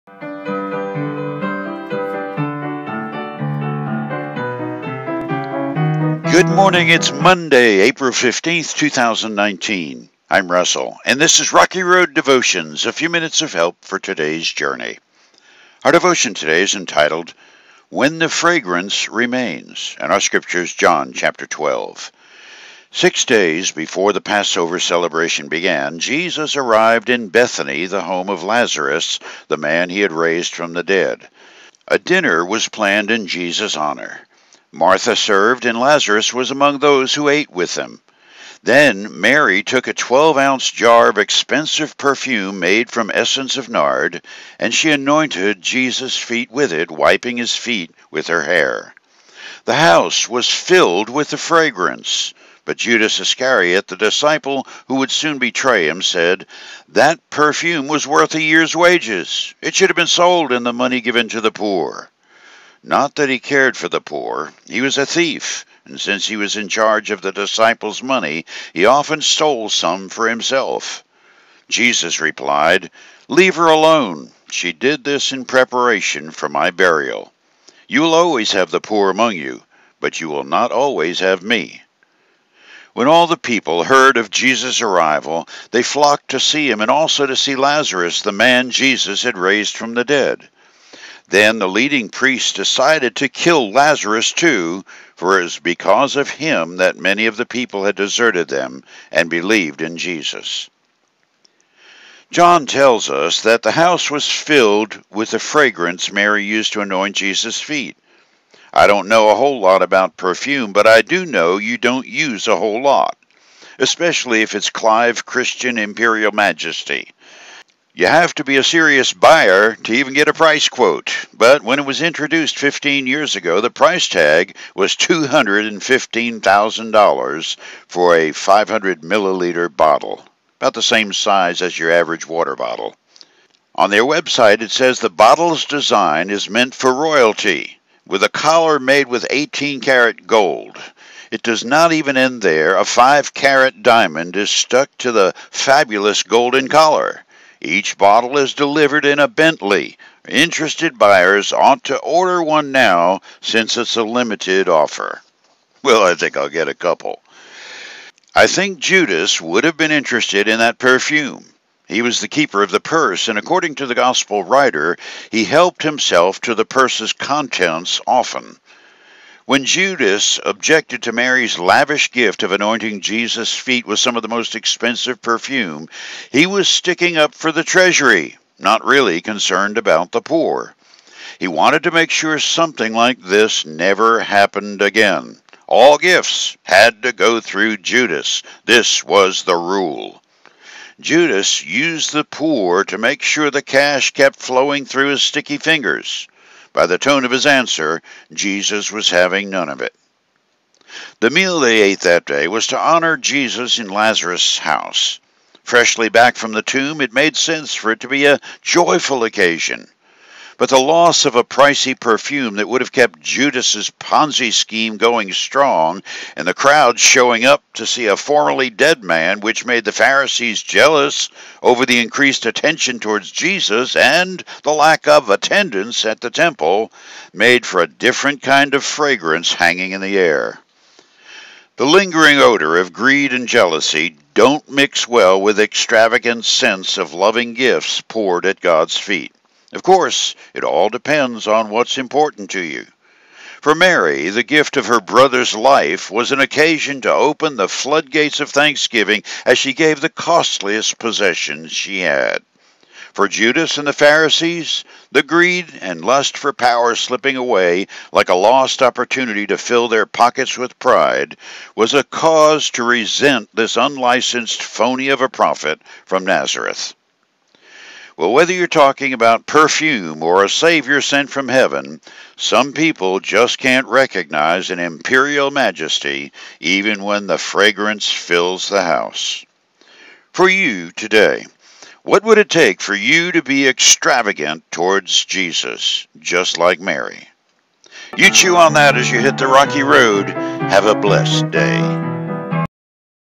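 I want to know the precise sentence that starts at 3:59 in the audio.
Of course, it all depends on what's important to you.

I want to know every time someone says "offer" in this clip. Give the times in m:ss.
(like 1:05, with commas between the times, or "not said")
2:34.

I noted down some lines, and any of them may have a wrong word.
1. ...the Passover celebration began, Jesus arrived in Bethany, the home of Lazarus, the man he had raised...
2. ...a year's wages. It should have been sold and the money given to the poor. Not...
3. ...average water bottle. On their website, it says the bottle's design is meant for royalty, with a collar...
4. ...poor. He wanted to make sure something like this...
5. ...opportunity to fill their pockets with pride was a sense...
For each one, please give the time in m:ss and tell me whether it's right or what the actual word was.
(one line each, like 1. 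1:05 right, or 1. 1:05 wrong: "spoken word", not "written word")
1. 0:24 right
2. 0:58 right
3. 2:11 right
4. 3:00 right
5. 4:18 wrong: "cause", not "sense".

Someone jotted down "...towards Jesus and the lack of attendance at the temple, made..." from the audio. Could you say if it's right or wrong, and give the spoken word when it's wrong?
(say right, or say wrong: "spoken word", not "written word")
right.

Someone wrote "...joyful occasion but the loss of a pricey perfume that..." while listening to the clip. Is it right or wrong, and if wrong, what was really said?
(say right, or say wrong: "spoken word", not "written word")
right.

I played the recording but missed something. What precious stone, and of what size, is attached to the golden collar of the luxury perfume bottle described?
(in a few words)
5 carat diamond.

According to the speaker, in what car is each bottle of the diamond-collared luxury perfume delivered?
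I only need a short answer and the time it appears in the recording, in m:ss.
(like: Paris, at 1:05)
Bentley, at 2:29.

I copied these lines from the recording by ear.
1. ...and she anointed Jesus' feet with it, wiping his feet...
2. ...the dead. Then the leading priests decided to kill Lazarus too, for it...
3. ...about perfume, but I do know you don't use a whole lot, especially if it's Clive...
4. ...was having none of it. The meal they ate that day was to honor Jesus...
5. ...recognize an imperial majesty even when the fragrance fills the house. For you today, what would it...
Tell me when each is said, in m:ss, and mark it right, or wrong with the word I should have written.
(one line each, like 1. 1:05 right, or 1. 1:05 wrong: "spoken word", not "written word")
1. 0:44 right
2. 1:29 right
3. 1:49 right
4. 3:18 right
5. 4:33 right.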